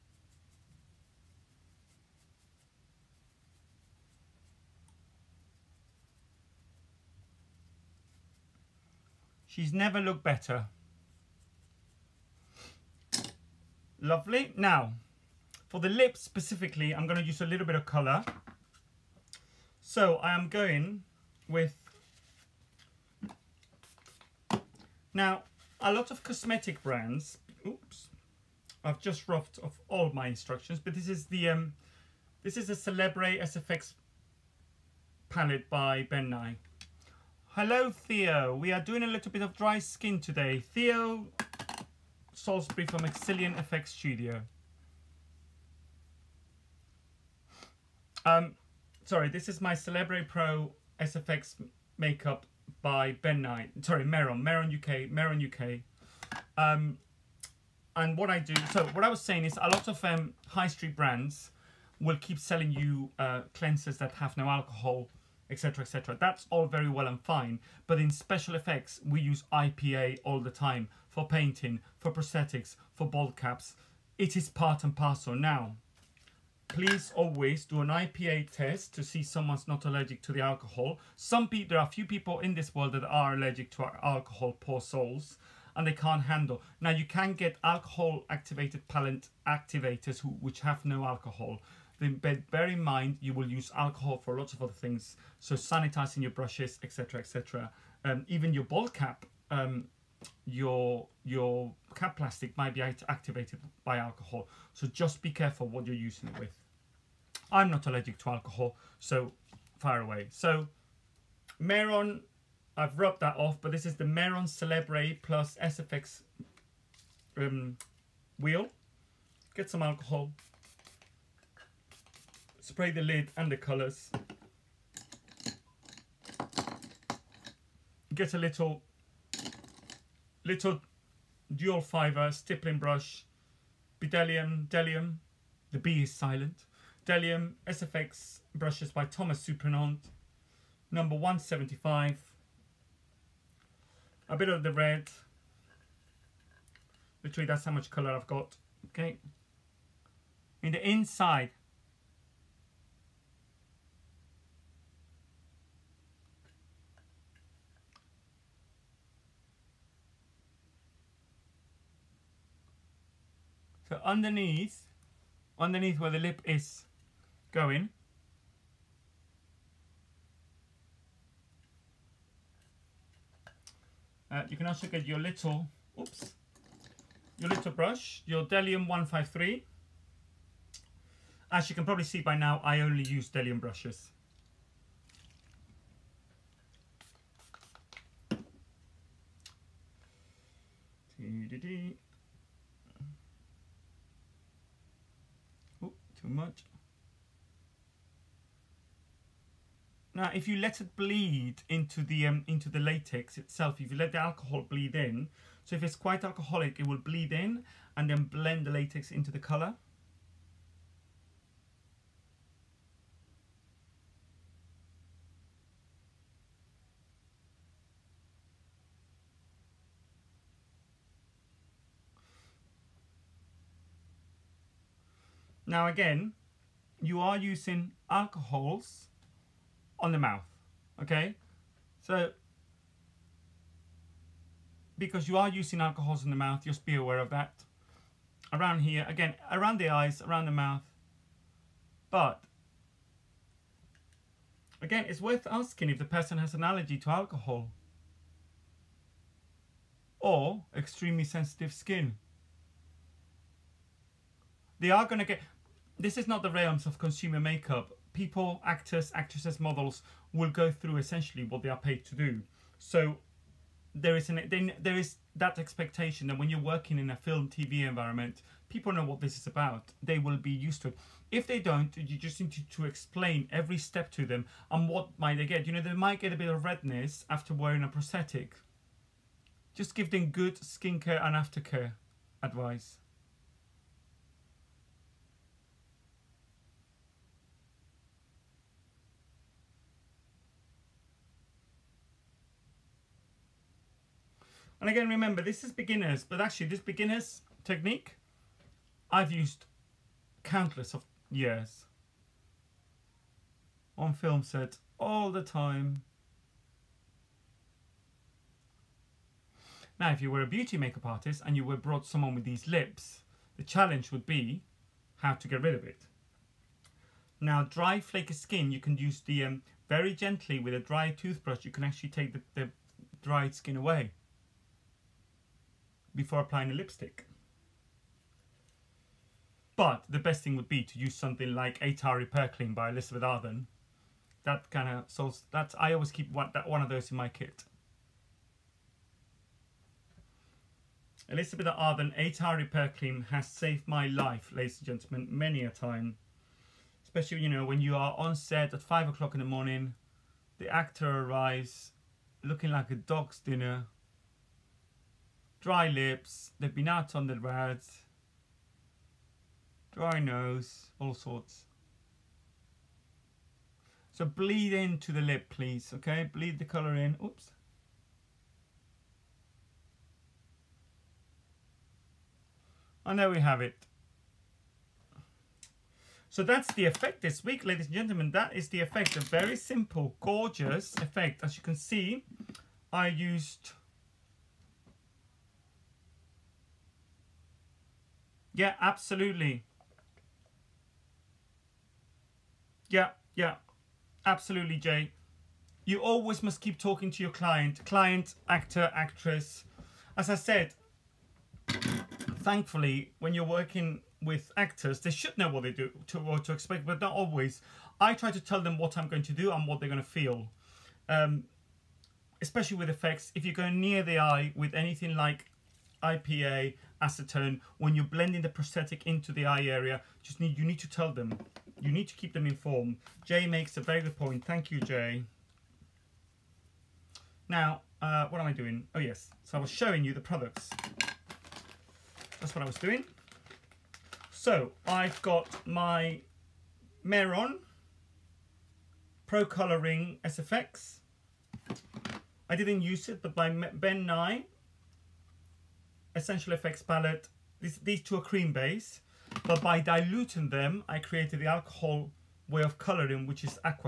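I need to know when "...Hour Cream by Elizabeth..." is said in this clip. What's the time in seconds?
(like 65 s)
332 s.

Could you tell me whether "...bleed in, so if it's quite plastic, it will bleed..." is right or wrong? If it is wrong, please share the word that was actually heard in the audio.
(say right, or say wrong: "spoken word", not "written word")
wrong: "alcoholic", not "plastic".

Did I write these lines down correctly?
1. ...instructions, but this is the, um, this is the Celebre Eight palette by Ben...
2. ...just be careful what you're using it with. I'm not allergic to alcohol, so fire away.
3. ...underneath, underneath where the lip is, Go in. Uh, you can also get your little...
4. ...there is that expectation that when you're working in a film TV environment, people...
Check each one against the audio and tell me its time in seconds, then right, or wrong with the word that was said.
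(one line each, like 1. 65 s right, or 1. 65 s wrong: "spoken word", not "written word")
1. 30 s wrong: "SFX", not "Eight"
2. 104 s right
3. 164 s right
4. 264 s right.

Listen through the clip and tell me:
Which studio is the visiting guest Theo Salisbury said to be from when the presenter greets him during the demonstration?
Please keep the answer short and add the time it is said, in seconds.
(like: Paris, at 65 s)
Exilian FX Studio, at 42 s.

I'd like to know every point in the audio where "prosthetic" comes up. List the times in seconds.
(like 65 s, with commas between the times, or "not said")
72 s, 277 s, 418 s.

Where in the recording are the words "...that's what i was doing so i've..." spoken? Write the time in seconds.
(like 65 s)
432 s.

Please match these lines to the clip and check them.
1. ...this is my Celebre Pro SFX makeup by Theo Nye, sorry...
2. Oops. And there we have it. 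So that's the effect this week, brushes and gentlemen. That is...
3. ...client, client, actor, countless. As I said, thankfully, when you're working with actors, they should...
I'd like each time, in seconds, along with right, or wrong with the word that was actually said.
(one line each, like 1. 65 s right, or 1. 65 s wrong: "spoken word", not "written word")
1. 49 s wrong: "Ben", not "Theo"
2. 367 s wrong: "ladies", not "brushes"
3. 397 s wrong: "actress", not "countless".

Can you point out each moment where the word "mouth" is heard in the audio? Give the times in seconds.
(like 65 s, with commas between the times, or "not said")
230 s, 236 s, 240 s.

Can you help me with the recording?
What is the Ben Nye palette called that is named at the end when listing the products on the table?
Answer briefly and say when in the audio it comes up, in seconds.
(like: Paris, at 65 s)
Essential Effects, at 446 s.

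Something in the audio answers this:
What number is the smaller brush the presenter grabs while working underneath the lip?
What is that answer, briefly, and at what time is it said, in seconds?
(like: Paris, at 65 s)
153, at 178 s.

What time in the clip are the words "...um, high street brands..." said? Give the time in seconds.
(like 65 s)
60 s.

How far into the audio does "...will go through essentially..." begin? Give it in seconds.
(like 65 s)
260 s.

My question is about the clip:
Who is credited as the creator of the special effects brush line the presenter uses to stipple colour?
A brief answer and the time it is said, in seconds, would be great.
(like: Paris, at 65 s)
Thomas Supernant, at 139 s.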